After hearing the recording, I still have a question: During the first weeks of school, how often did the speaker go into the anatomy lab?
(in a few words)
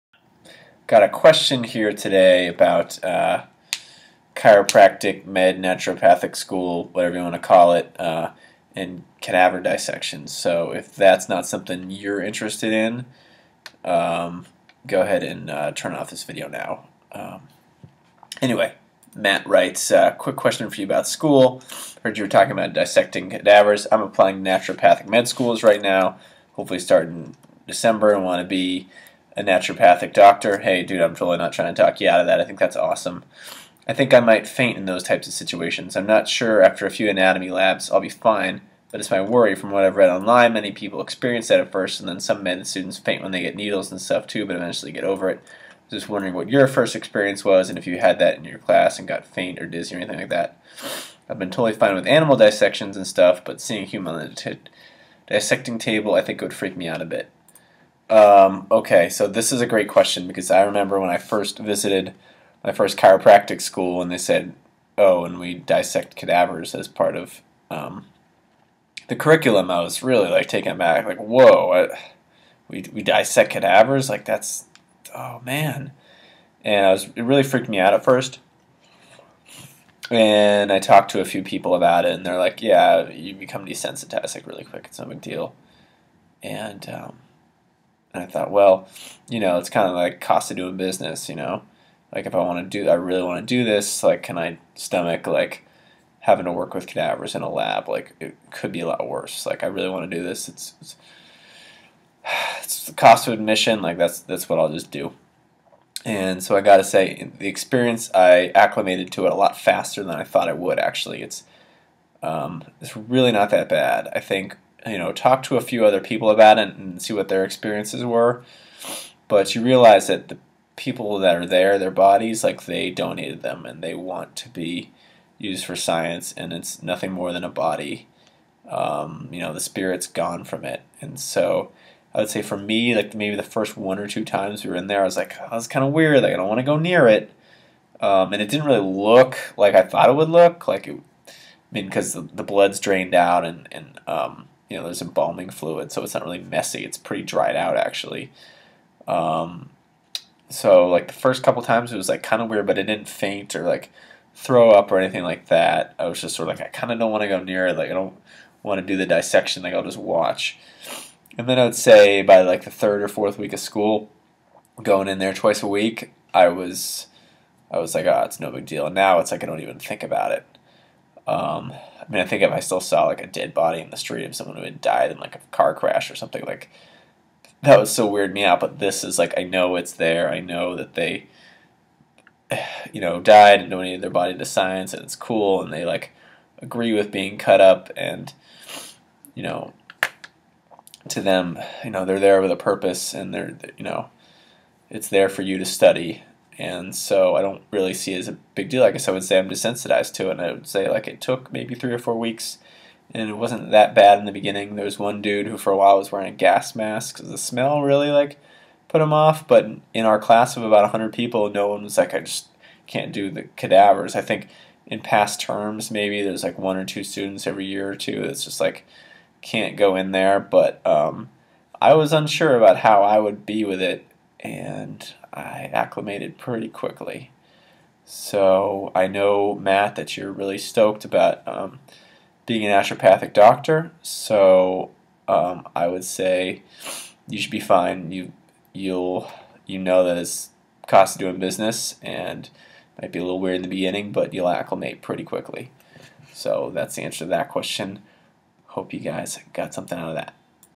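Twice a week.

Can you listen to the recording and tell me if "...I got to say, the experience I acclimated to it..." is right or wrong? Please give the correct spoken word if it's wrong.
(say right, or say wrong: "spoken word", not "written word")
right.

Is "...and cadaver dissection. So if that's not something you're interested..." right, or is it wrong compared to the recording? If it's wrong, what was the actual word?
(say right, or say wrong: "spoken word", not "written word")
right.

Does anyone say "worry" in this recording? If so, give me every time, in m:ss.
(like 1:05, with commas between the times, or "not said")
0:39.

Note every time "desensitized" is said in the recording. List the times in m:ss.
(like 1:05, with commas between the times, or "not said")
1:23, 3:19.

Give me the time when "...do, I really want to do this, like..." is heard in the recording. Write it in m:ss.
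1:32.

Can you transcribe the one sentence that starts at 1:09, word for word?
I was really like taken aback, like, whoa, I, we, we dissect cadavers?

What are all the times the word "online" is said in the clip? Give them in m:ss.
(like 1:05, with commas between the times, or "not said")
0:40.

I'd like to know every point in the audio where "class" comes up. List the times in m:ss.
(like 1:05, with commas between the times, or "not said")
0:48, 3:30.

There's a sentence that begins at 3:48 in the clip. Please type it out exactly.
So I know, Matt, that you're really stoked about um, being an naturopathic doctor.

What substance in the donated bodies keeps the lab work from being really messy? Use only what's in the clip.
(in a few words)
Embalming fluid.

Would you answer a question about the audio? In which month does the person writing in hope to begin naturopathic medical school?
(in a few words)
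December.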